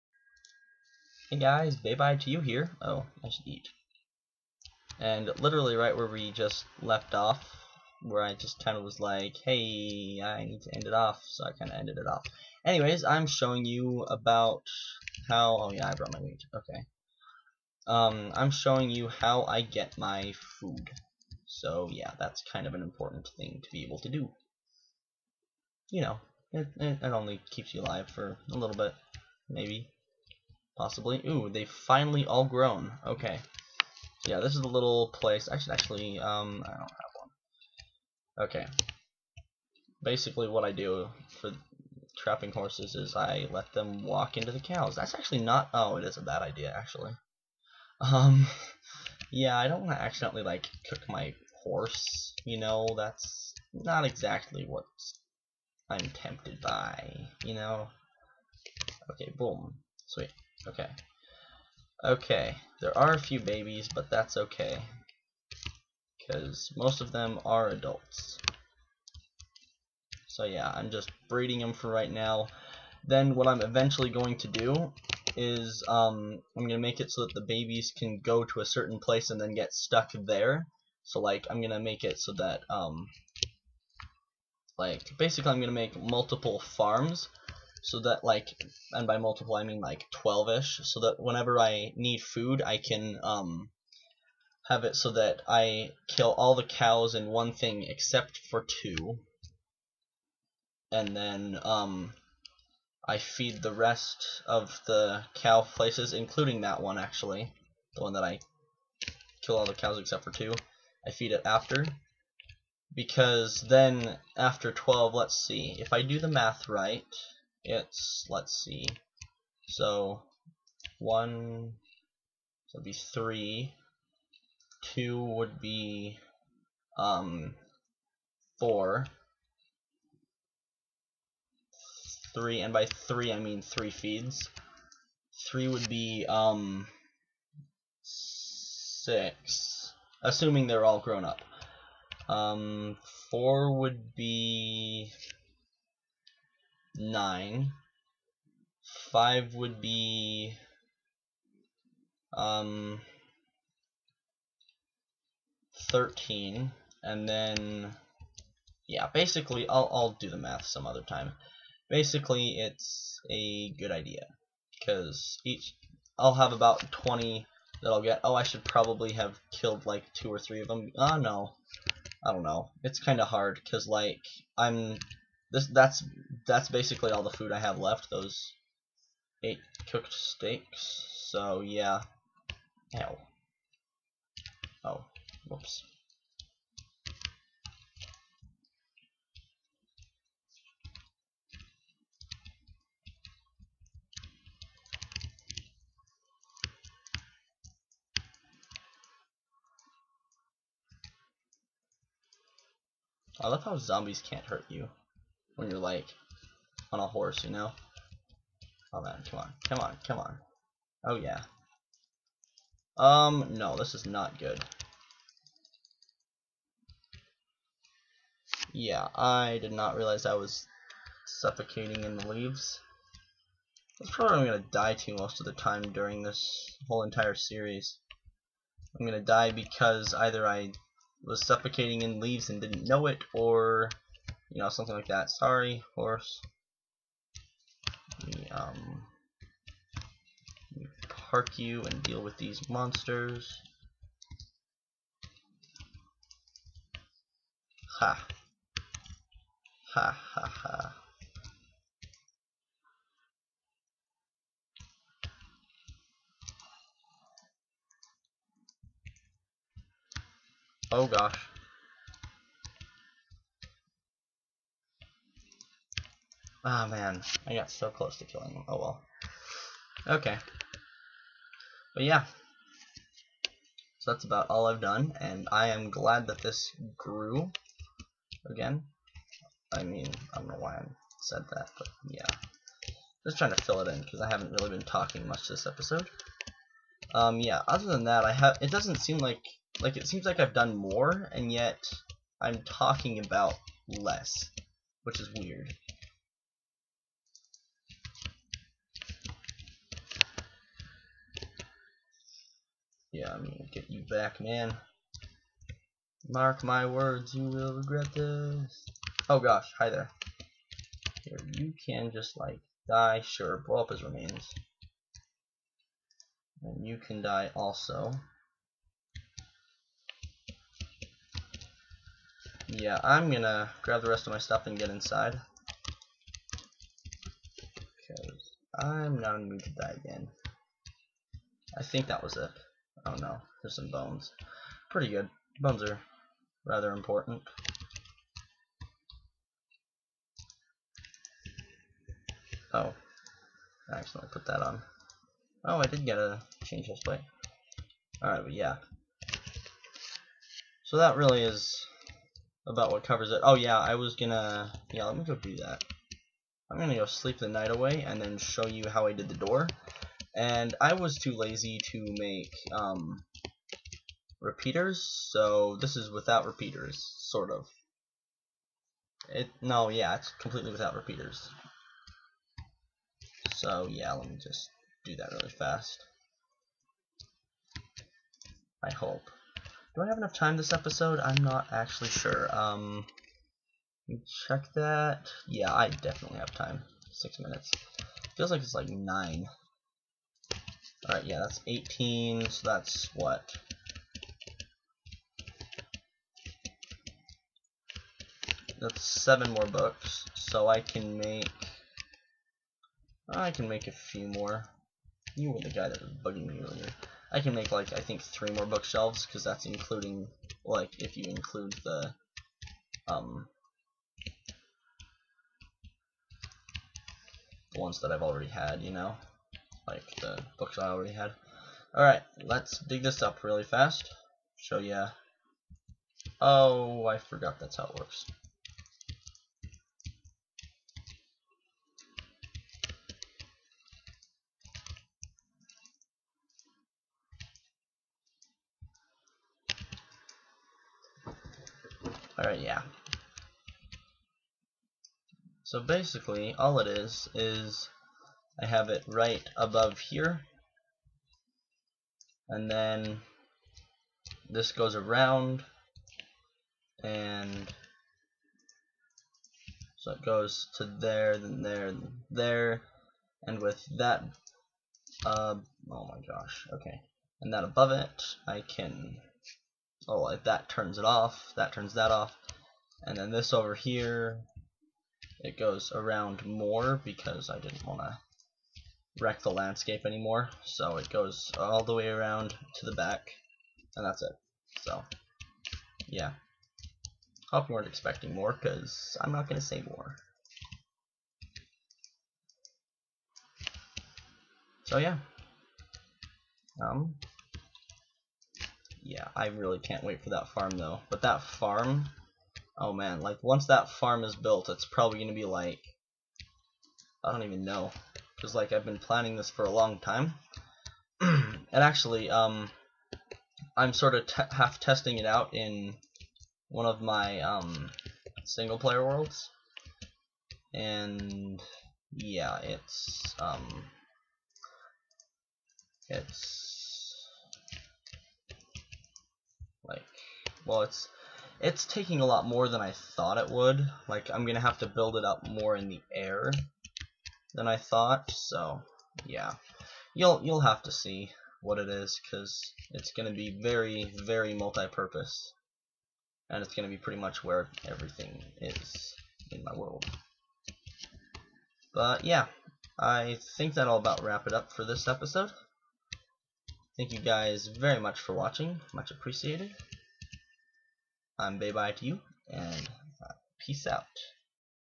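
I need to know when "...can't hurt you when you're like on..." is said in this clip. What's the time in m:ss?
3:24.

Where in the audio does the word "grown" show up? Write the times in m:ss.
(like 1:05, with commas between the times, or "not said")
0:32, 2:20.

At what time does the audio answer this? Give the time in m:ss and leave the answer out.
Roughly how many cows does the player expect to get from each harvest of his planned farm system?
2:46.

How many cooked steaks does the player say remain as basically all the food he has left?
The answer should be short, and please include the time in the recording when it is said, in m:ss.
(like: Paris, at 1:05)
8, at 2:59.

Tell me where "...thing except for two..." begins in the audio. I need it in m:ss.
1:37.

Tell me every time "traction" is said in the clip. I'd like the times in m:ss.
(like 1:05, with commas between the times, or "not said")
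not said.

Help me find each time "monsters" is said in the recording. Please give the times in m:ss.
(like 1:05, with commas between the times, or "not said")
4:02.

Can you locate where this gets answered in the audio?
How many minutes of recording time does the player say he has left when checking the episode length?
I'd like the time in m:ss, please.
6:27.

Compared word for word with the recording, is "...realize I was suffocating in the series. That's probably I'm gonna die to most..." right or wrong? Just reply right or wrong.
wrong.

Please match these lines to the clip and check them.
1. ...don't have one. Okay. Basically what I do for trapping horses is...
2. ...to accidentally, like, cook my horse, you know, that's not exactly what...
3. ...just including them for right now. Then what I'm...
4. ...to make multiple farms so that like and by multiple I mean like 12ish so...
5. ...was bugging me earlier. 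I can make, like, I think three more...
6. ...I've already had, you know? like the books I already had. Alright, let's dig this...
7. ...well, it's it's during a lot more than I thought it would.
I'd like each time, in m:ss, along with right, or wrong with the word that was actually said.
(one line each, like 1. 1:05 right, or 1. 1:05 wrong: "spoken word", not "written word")
1. 0:36 right
2. 0:49 right
3. 1:10 wrong: "breeding", not "including"
4. 1:25 right
5. 6:46 right
6. 6:58 right
7. 8:50 wrong: "taking", not "during".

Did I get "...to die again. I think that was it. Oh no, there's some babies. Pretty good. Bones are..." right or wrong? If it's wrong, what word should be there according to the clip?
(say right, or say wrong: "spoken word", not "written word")
wrong: "bones", not "babies".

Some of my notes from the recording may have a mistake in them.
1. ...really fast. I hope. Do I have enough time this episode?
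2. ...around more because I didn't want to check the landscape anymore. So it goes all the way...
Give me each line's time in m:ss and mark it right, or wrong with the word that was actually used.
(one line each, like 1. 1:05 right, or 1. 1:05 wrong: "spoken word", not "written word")
1. 6:15 right
2. 7:55 wrong: "wreck", not "check".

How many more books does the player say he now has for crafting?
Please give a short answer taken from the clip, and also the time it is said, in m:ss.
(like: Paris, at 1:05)
7, at 6:39.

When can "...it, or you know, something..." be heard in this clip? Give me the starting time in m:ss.
3:53.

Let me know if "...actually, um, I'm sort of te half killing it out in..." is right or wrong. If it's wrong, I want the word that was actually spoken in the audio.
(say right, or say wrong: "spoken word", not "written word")
wrong: "testing", not "killing".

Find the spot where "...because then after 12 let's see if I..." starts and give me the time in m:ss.
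1:52.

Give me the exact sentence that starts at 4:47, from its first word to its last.
Um, yeah, other than that, I have.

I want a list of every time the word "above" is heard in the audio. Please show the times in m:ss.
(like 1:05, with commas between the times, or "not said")
7:29, 7:47.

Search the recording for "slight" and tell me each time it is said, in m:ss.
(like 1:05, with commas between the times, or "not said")
not said.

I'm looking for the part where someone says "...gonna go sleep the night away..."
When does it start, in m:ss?
5:56.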